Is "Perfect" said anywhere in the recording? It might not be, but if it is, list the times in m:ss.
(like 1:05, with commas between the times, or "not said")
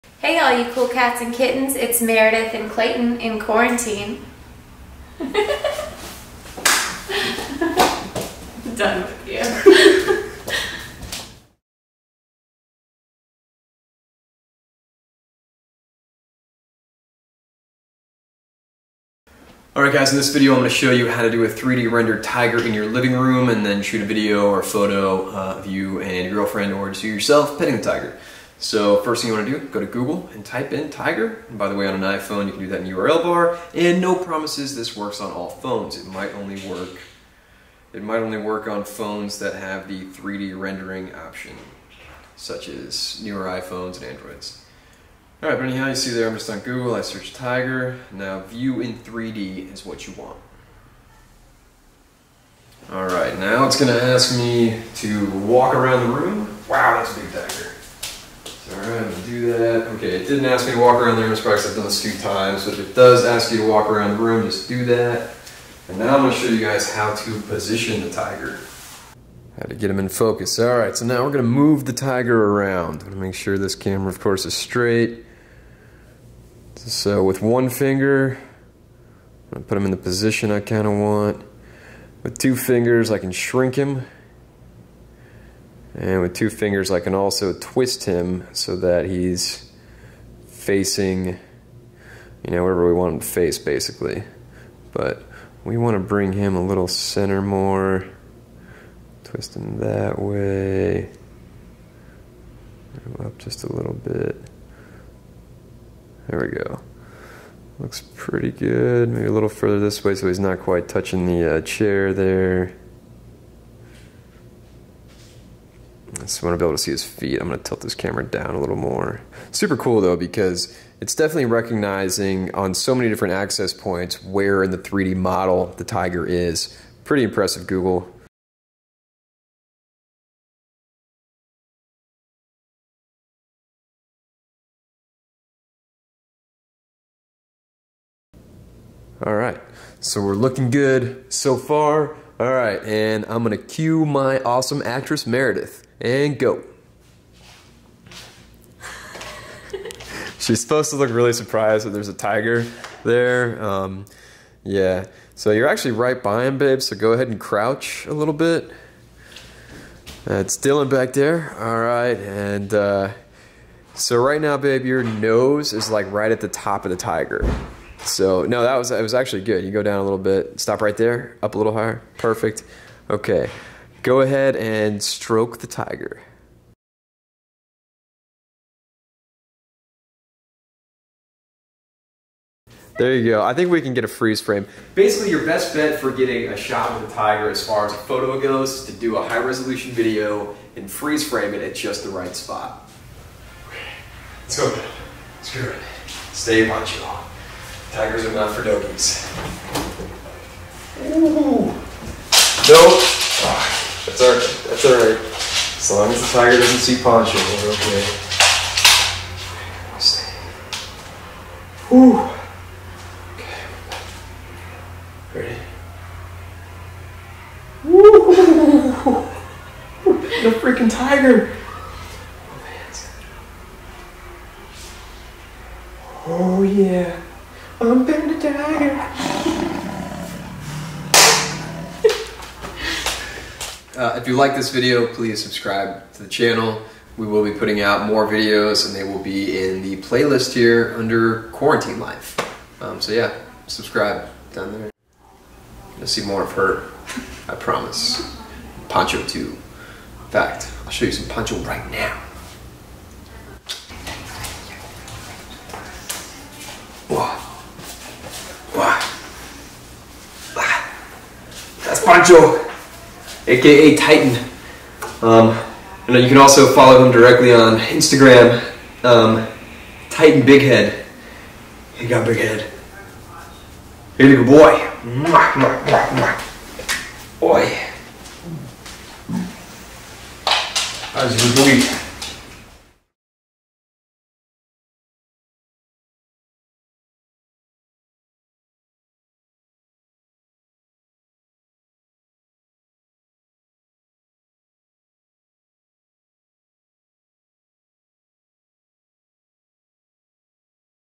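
2:52.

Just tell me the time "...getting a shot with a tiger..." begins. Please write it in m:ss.
3:06.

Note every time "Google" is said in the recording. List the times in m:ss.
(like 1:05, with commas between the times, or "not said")
0:29, 0:46, 2:07.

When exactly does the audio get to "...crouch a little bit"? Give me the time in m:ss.
2:37.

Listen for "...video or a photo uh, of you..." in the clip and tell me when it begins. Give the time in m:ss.
0:24.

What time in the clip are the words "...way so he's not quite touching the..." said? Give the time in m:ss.
1:50.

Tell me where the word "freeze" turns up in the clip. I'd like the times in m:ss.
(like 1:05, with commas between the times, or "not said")
3:04, 3:10.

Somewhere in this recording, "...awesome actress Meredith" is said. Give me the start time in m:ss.
2:24.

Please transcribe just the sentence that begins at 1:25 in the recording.
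And with two fingers, I can also twist him so that he's facing, you know, wherever we want him to face, basically.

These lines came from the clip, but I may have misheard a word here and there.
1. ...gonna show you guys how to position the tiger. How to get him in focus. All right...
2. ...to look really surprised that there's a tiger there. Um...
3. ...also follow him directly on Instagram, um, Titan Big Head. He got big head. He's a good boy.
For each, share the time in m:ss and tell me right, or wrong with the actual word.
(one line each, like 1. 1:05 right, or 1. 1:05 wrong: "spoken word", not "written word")
1. 1:06 right
2. 2:30 right
3. 4:26 right.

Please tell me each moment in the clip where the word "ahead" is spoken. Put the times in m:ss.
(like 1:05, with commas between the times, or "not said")
2:37, 2:54.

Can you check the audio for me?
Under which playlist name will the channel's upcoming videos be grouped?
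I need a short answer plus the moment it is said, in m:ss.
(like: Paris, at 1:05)
Quarantine Life, at 4:01.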